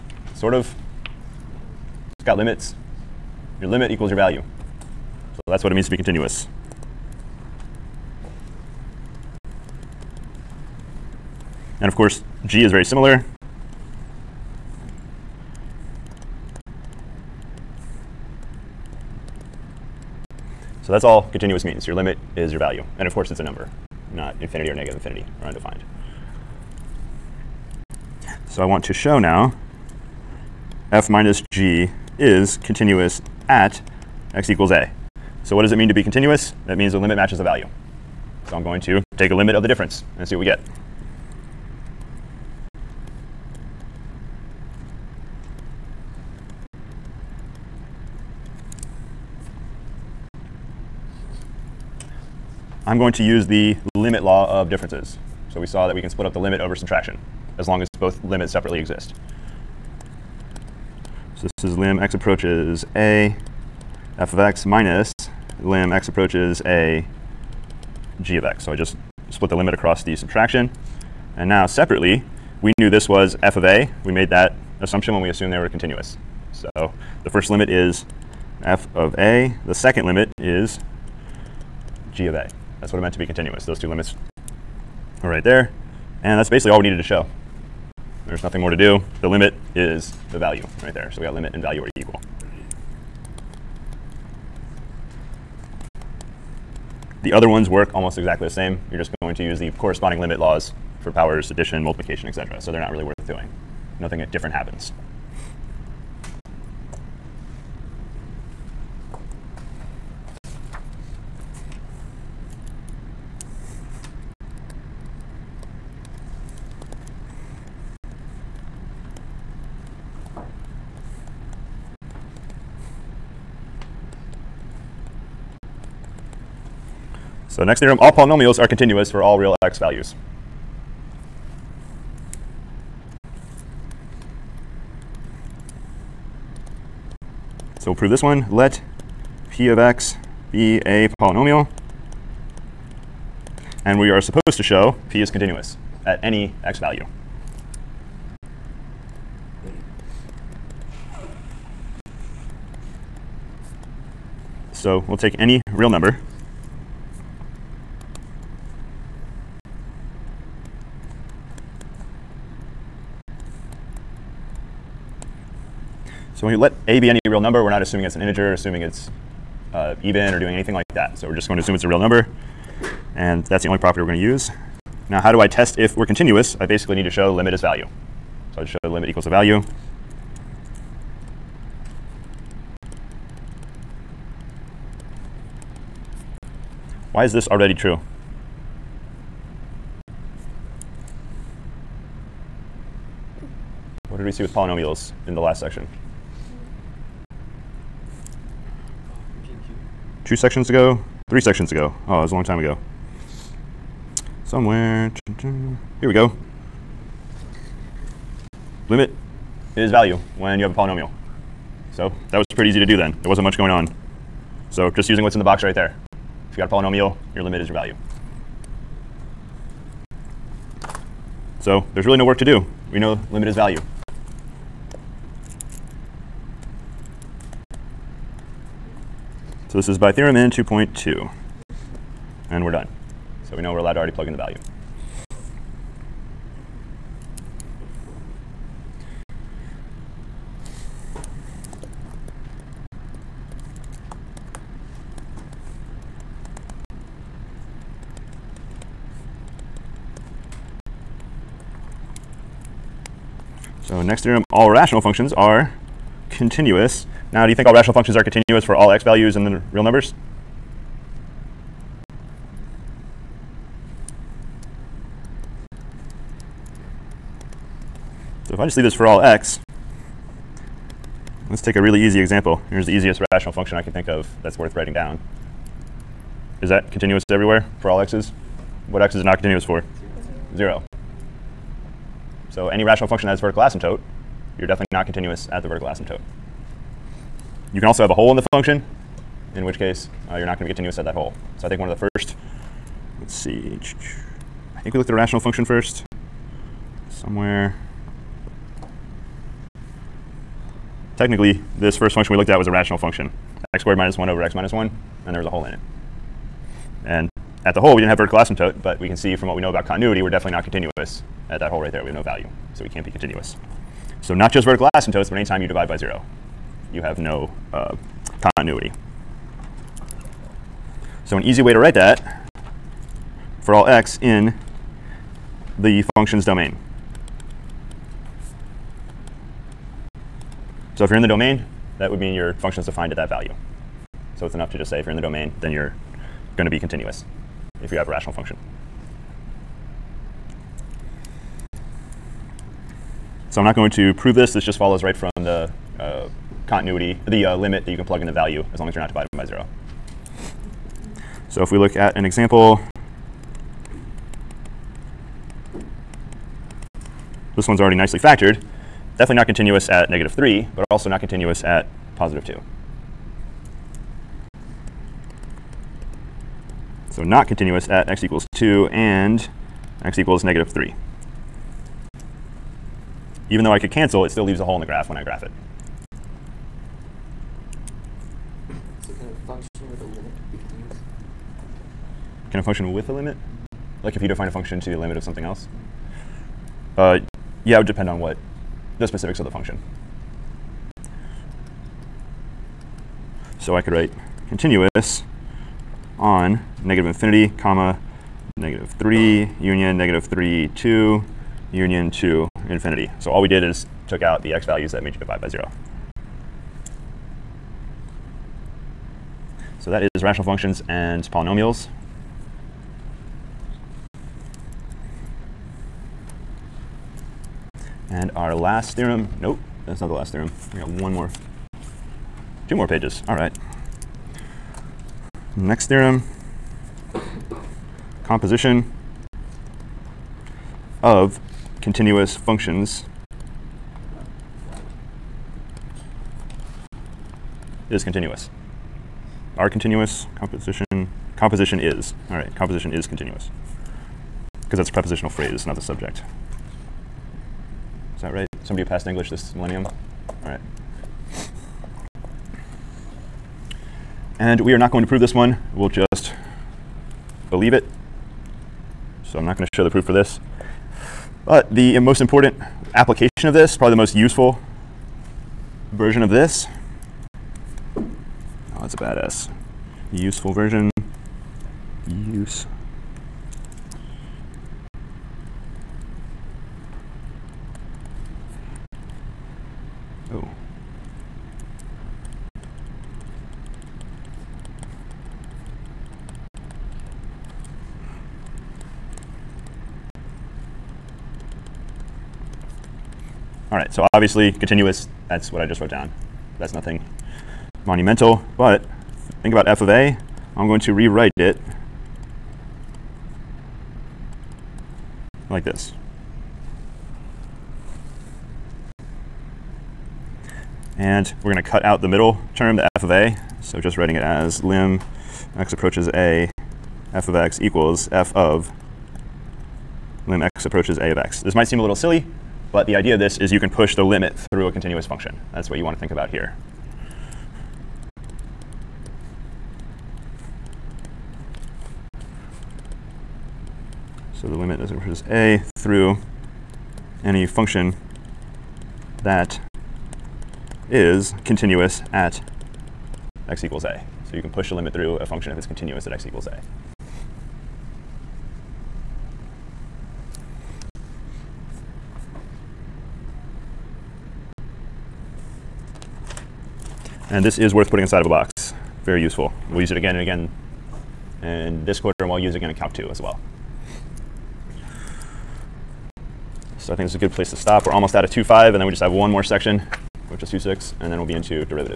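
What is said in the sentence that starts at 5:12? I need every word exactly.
We have no value, so we can't be continuous.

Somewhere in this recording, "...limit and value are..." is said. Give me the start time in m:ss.
1:31.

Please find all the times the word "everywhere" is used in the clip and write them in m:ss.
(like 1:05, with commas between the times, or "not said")
4:37.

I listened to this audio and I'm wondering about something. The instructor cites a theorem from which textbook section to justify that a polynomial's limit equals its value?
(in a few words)
2.2.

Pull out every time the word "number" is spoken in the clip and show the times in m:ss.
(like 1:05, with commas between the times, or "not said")
0:23, 2:35, 2:47, 2:51, 4:19.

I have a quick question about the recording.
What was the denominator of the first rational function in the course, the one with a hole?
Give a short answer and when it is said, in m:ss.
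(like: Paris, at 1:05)
x minus 1, at 5:04.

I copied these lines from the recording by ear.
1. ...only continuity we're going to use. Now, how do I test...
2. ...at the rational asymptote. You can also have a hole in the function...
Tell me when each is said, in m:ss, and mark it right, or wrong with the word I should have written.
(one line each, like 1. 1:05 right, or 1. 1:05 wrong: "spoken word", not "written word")
1. 2:53 wrong: "property", not "continuity"
2. 4:45 wrong: "vertical", not "rational".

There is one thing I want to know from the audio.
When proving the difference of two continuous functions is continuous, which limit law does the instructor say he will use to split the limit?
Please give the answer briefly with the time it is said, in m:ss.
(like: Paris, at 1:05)
limit law of differences, at 0:53.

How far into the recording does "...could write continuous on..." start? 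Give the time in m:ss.
6:33.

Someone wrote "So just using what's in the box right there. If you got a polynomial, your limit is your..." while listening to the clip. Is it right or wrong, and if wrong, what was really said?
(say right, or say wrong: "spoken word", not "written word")
right.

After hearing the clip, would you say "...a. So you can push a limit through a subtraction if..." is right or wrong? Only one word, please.
wrong.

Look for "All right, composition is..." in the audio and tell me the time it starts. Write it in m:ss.
7:22.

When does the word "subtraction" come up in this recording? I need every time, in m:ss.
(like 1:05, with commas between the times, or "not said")
0:56, 1:10.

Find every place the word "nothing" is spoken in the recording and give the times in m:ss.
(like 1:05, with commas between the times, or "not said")
1:28, 1:43, 8:16.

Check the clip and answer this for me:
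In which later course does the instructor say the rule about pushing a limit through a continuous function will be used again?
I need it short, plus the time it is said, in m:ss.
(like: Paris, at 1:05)
Calc 2, at 9:22.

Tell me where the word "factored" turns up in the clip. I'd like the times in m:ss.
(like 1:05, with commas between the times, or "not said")
5:58.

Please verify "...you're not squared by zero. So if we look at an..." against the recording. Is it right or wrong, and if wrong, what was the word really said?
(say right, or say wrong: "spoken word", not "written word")
wrong: "divided", not "squared".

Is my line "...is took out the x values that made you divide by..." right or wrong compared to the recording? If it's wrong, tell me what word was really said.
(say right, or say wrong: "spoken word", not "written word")
right.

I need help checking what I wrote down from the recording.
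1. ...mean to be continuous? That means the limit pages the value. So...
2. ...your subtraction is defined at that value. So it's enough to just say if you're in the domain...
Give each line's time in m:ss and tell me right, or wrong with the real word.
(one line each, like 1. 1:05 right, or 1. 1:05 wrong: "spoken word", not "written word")
1. 0:35 wrong: "matches", not "pages"
2. 5:32 wrong: "function", not "subtraction".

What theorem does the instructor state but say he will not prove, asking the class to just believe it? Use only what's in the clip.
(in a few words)
composition of continuous functions is continuous.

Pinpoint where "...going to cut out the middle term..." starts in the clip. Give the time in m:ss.
8:31.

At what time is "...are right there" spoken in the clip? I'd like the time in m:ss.
1:25.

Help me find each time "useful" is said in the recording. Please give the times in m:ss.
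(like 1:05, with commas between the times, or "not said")
7:44, 7:50, 9:19.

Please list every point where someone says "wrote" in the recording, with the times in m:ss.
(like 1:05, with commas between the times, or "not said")
8:15.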